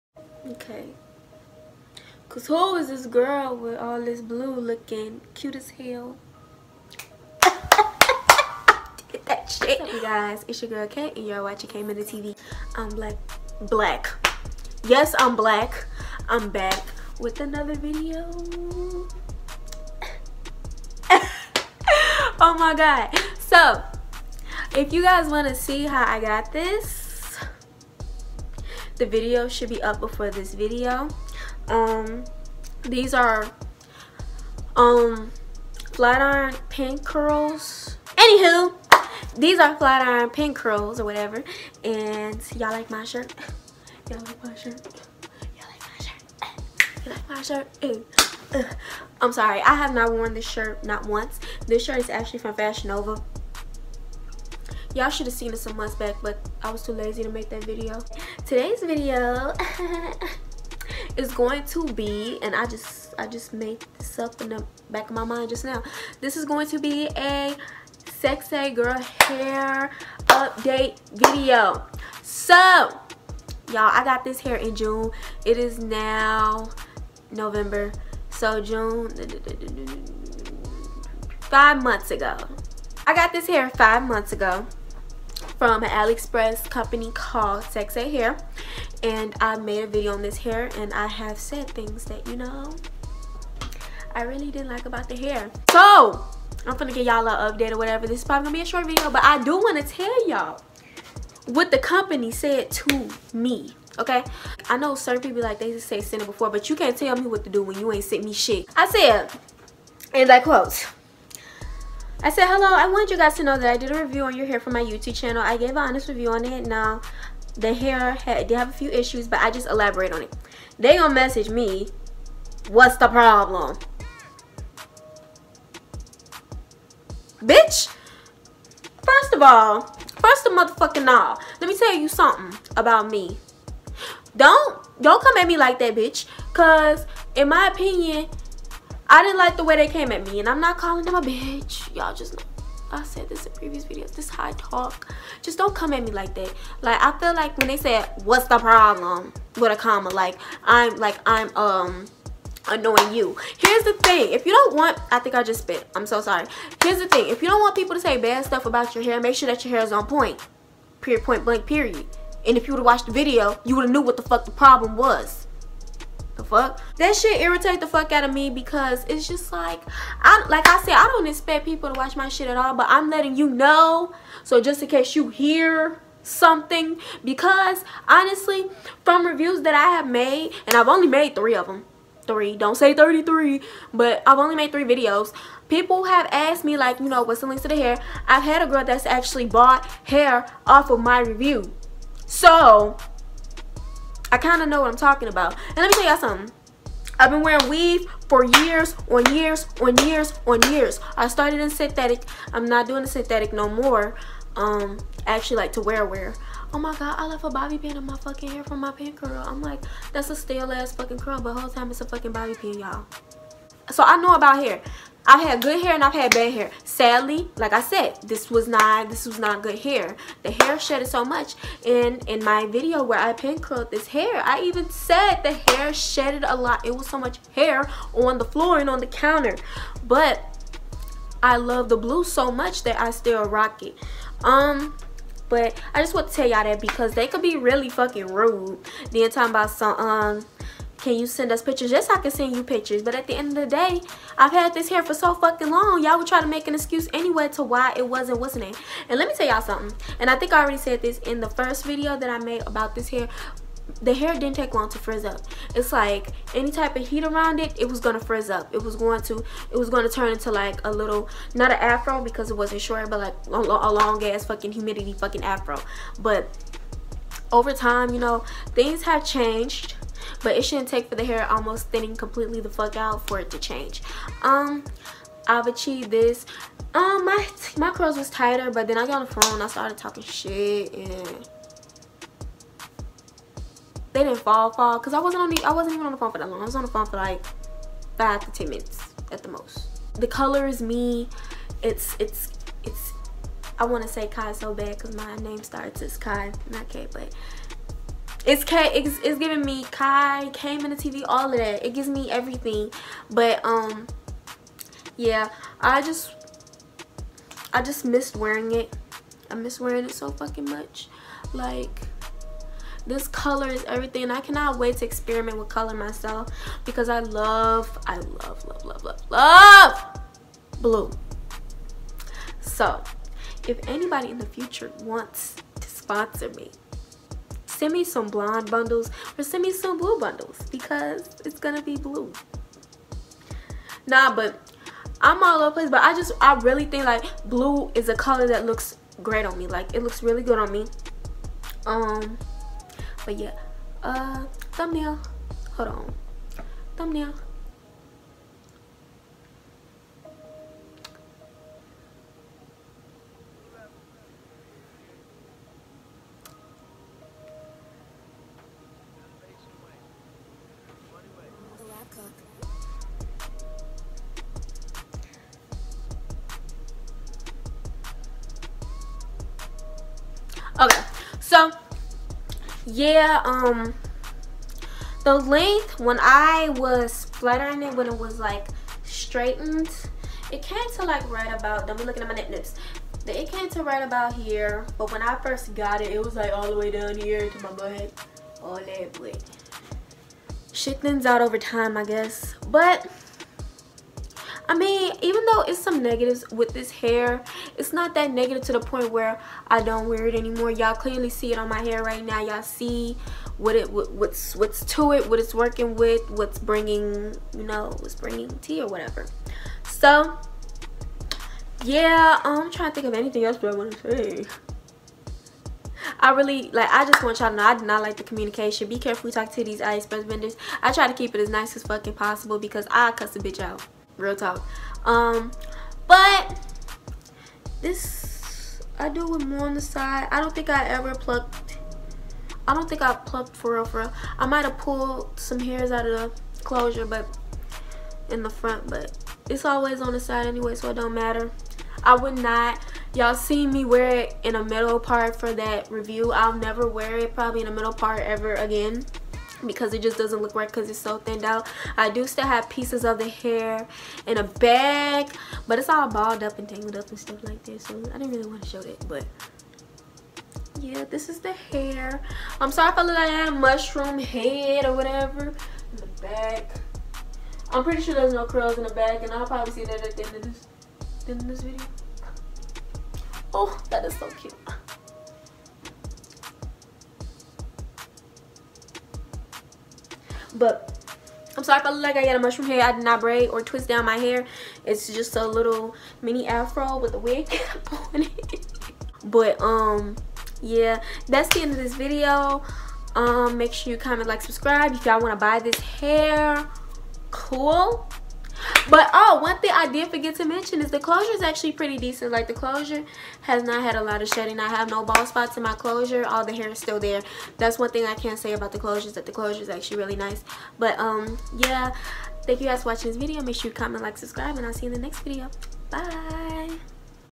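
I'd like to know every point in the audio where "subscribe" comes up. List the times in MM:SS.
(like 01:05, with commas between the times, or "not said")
08:14, 08:34.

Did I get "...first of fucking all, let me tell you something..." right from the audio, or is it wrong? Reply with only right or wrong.
wrong.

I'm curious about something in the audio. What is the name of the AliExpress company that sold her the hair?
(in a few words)
Sexay Hair.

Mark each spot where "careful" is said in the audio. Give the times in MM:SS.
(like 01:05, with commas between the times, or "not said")
06:58.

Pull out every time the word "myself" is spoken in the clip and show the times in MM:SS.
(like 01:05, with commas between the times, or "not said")
05:15.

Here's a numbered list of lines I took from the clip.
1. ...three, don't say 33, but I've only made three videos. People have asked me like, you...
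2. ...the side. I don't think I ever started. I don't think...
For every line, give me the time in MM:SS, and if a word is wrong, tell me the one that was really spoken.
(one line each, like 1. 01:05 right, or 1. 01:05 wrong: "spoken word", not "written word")
1. 03:02 right
2. 07:09 wrong: "plucked", not "started".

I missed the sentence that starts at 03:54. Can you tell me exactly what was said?
Um, but I just want to tell y'all that because they could be really fucking rude.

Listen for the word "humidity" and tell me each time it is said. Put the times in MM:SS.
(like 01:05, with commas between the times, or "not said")
04:24.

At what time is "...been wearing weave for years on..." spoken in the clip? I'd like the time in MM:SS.
03:17.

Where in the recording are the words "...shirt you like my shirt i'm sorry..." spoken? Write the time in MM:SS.
00:47.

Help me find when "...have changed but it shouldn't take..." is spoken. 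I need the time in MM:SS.
04:29.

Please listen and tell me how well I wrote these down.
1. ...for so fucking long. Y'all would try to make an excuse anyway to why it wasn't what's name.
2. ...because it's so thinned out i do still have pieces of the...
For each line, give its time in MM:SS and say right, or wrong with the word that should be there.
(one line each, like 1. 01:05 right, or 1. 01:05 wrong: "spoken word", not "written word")
1. 04:05 right
2. 07:30 right.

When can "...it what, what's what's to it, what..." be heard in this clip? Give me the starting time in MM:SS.
06:43.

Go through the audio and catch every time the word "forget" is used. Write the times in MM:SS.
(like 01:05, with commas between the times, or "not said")
08:20.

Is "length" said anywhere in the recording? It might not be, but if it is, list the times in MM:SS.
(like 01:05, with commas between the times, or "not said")
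06:15.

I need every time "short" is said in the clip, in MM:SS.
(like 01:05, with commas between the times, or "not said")
01:38, 04:22.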